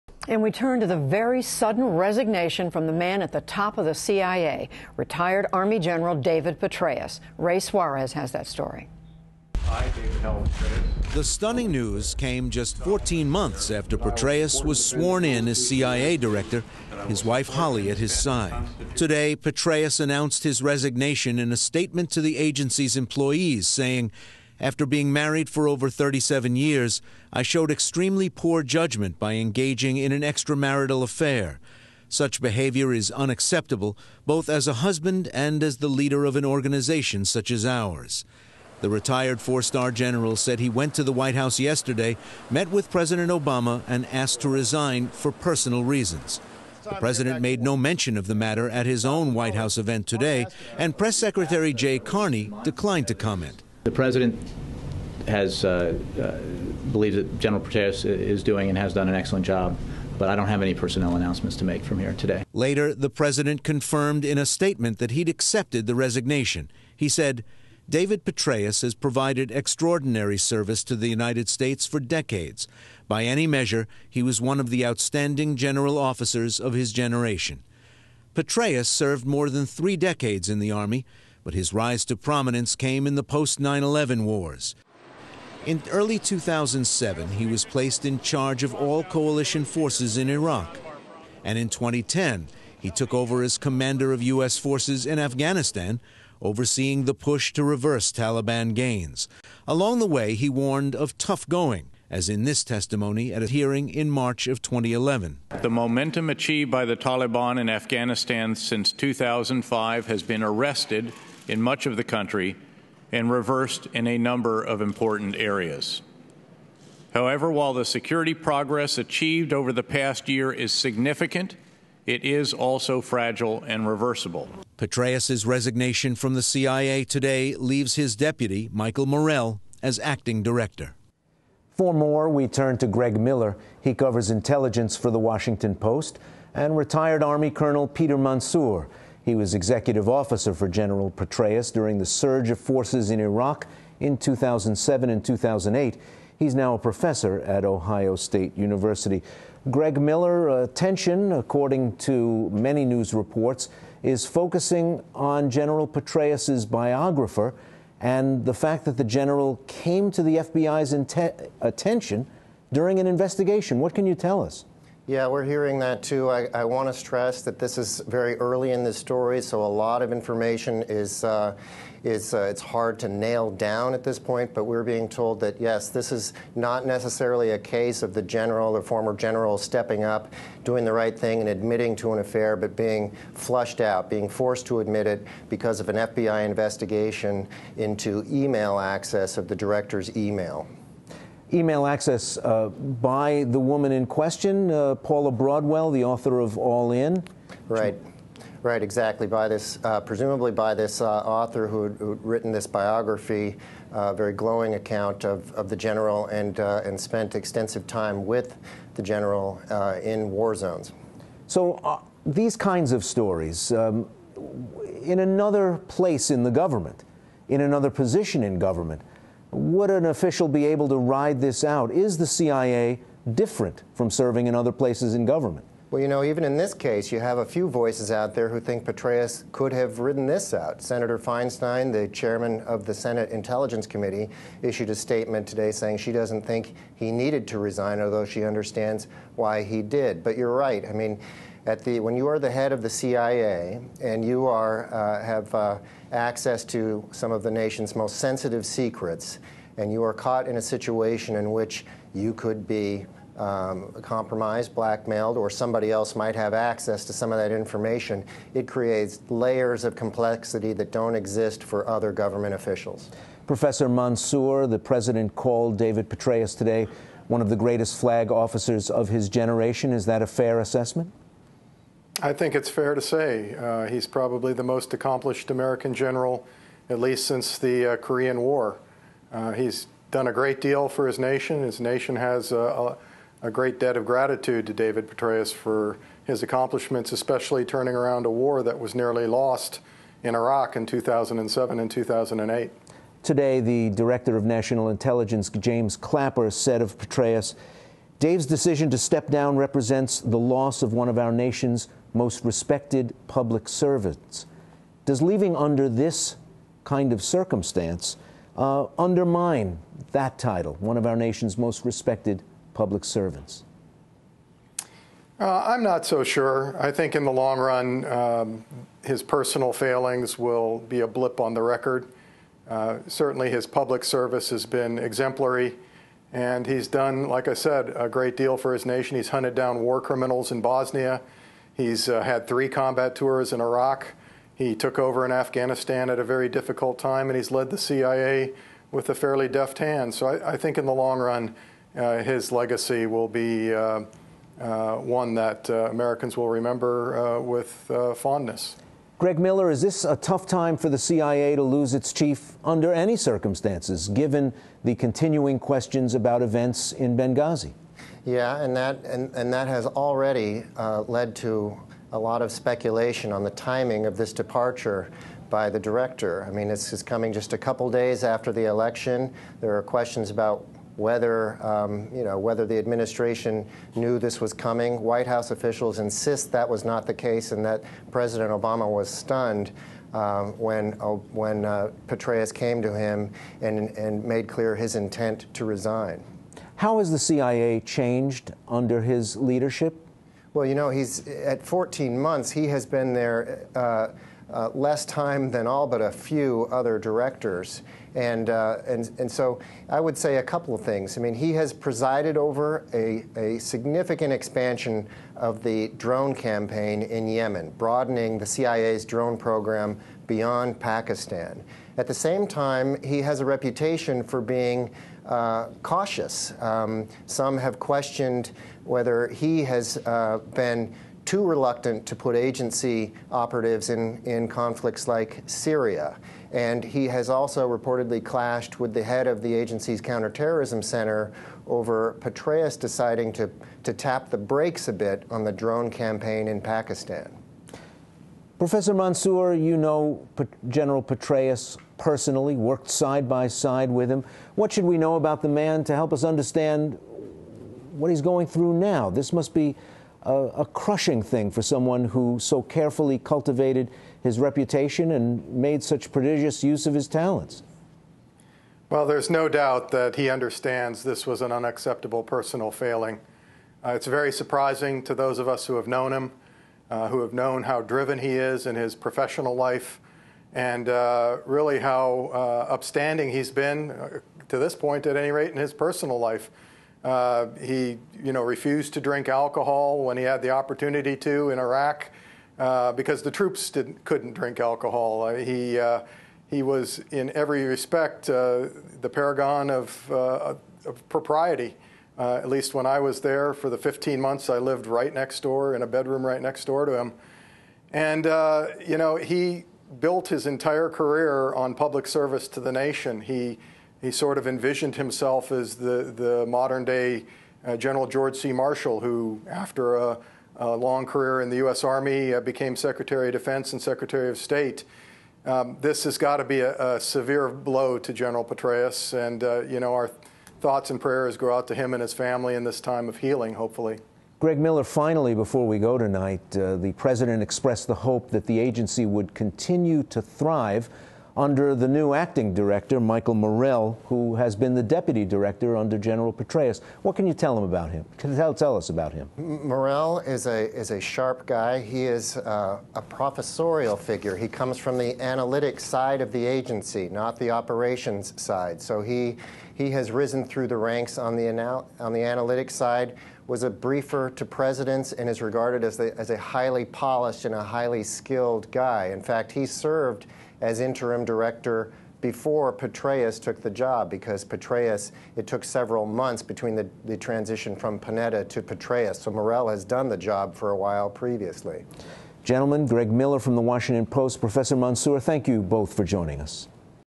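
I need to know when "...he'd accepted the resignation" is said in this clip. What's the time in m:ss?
1:05.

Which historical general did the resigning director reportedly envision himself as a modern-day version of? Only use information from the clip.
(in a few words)
George C. Marshall.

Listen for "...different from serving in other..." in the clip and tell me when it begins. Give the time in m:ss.
3:43.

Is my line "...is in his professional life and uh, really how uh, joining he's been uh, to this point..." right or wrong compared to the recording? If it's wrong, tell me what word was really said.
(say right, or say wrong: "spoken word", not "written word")
wrong: "upstanding", not "joining".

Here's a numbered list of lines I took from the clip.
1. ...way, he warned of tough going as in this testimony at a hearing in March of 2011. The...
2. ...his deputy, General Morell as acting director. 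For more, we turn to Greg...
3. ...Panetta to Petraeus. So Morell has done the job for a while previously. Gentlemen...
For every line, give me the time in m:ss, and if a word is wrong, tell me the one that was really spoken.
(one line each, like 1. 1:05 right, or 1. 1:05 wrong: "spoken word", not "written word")
1. 1:40 right
2. 2:07 wrong: "Michael", not "General"
3. 9:27 right.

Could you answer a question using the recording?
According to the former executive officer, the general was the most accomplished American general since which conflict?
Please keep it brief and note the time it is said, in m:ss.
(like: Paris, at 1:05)
Korean War, at 4:37.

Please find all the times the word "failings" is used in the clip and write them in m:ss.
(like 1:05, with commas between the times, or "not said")
5:19, 7:42.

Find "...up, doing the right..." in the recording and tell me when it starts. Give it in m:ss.
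3:00.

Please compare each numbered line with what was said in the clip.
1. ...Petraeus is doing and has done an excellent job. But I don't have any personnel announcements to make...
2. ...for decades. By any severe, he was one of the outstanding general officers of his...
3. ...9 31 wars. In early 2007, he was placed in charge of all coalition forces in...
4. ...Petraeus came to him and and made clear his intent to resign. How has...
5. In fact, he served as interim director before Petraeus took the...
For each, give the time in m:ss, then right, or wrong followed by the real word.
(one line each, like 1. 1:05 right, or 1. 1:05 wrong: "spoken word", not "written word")
1. 0:57 right
2. 1:11 wrong: "measure", not "severe"
3. 1:23 wrong: "11", not "31"
4. 6:22 right
5. 9:19 right.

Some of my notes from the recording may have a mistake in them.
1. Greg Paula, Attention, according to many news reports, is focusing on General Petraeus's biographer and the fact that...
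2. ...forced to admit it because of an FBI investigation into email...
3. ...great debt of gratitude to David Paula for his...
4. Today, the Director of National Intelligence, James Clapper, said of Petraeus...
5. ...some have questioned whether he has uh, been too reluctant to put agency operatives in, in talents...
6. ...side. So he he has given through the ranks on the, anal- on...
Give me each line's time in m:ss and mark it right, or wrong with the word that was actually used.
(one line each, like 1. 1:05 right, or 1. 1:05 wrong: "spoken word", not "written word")
1. 2:29 wrong: "Miller", not "Paula"
2. 3:04 right
3. 4:43 wrong: "Petraeus", not "Paula"
4. 4:53 right
5. 6:57 wrong: "conflicts", not "talents"
6. 9:08 wrong: "risen", not "given".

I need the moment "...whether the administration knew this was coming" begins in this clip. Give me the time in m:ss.
6:12.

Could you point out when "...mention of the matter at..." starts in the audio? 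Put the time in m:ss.
0:47.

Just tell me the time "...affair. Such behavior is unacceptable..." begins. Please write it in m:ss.
0:31.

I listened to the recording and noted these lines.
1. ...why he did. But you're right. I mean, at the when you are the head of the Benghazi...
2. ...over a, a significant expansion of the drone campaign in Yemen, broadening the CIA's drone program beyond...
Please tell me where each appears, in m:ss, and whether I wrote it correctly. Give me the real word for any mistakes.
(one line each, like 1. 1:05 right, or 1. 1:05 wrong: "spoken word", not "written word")
1. 3:59 wrong: "CIA", not "Benghazi"
2. 6:42 right.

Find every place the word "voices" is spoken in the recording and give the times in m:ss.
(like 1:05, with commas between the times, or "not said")
3:47.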